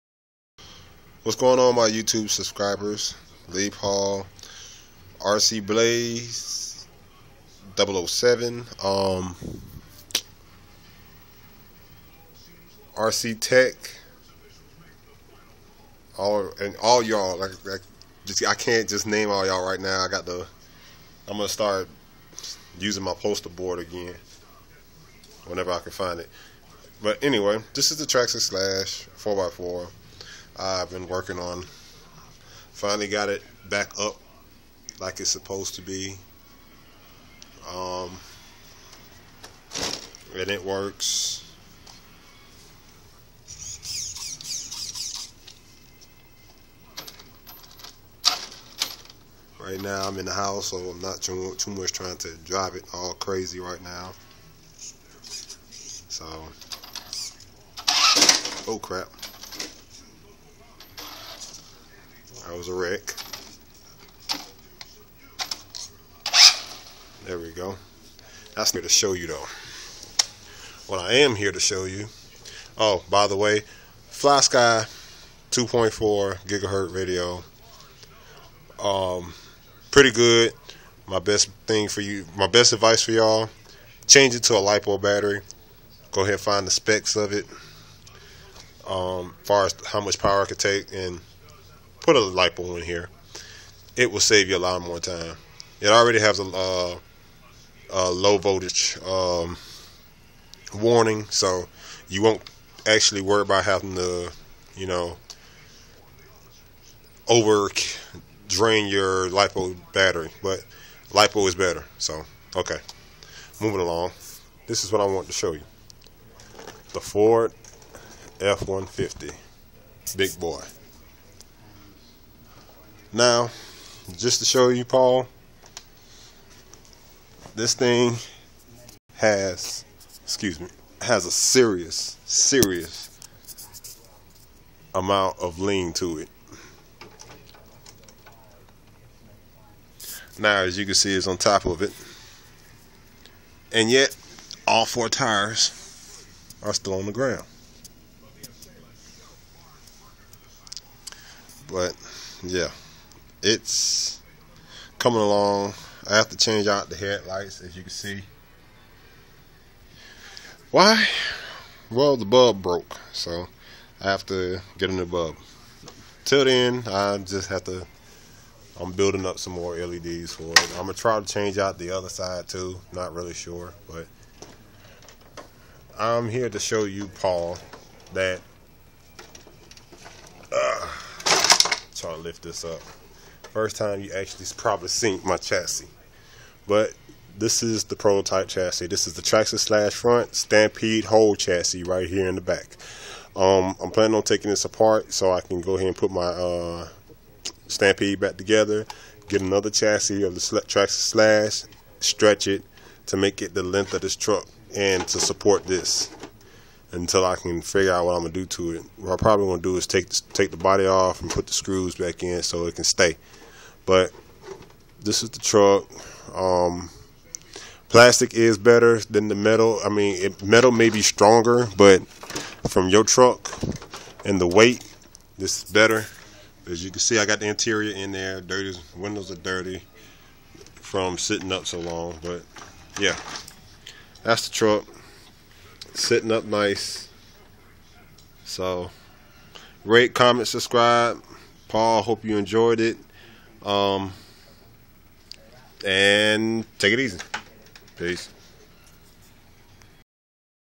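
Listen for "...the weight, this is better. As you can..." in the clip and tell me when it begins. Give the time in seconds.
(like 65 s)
224 s.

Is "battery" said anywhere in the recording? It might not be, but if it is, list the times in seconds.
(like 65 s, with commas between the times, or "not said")
85 s, 109 s.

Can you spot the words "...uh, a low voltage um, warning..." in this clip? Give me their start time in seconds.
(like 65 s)
96 s.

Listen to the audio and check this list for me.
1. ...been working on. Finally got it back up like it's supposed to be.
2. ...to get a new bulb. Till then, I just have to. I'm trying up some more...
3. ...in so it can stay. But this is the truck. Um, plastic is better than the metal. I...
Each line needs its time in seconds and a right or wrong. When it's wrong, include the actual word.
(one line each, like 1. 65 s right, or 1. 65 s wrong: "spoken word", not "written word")
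1. 30 s right
2. 164 s wrong: "building", not "trying"
3. 212 s right.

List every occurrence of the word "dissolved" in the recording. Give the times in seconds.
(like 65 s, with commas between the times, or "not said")
not said.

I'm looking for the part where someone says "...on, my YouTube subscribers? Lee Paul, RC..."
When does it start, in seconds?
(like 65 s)
1 s.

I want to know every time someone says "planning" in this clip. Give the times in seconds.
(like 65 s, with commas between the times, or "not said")
193 s.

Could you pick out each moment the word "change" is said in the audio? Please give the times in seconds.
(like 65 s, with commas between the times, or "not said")
84 s, 156 s, 171 s.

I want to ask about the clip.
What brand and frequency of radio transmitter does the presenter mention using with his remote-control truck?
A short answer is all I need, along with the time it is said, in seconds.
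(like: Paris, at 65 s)
FlySky 2.4 gigahertz, at 74 s.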